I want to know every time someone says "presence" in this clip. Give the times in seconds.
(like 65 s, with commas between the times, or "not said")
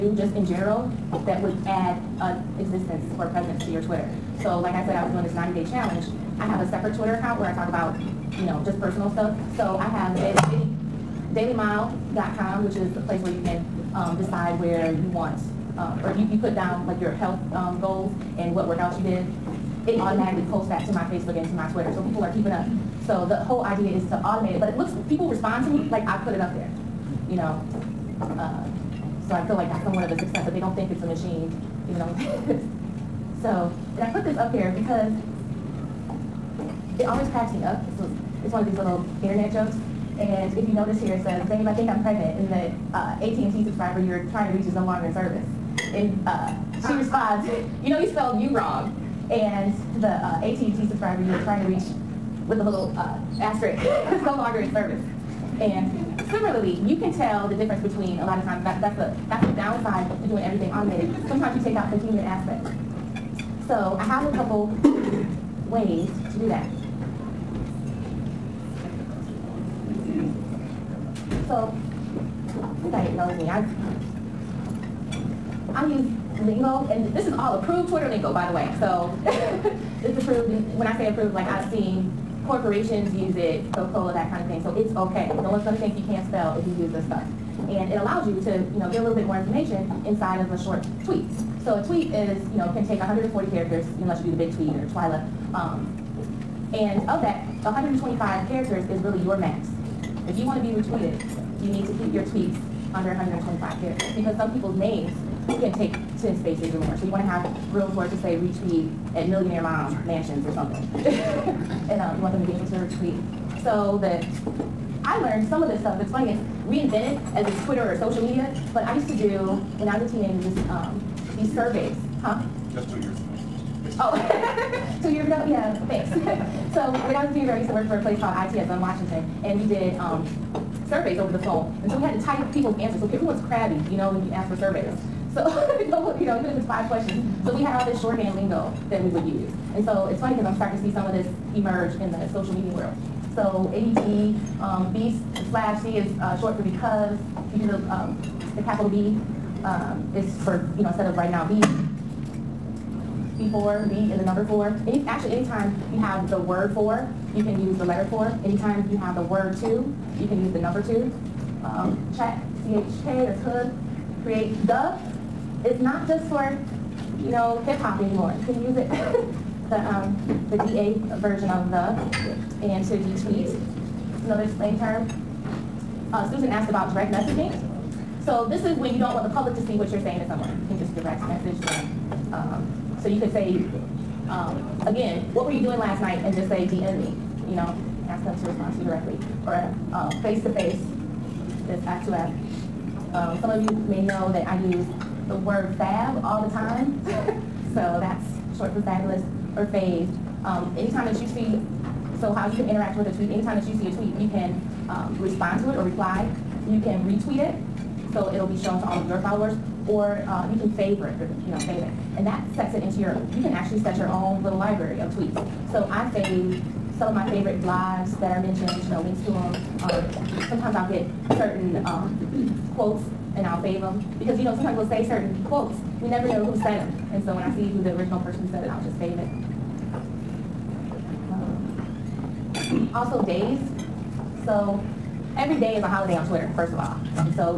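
3 s.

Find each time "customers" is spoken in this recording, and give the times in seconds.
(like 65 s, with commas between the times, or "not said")
not said.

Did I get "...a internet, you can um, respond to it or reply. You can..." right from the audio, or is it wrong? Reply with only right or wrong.
wrong.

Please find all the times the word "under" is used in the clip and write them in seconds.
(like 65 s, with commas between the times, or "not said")
102 s.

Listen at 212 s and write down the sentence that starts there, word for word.
And that sets it into your, you can actually set your own little library of tweets.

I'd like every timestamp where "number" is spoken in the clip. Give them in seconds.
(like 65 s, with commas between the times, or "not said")
154 s, 160 s.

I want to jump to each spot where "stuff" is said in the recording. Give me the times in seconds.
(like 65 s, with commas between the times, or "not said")
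9 s, 87 s, 115 s.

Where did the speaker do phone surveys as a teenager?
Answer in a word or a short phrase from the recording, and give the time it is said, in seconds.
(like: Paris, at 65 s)
ITSM Washington, at 128 s.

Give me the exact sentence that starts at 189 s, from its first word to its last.
Or face-to-face, um, -face, it's act to Um, some of you may know that I use the word fab all the time.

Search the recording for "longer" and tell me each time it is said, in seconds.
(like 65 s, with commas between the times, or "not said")
44 s, 54 s.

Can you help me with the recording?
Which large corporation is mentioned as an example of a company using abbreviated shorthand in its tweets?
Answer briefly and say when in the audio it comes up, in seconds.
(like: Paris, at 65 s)
Coca-Cola, at 83 s.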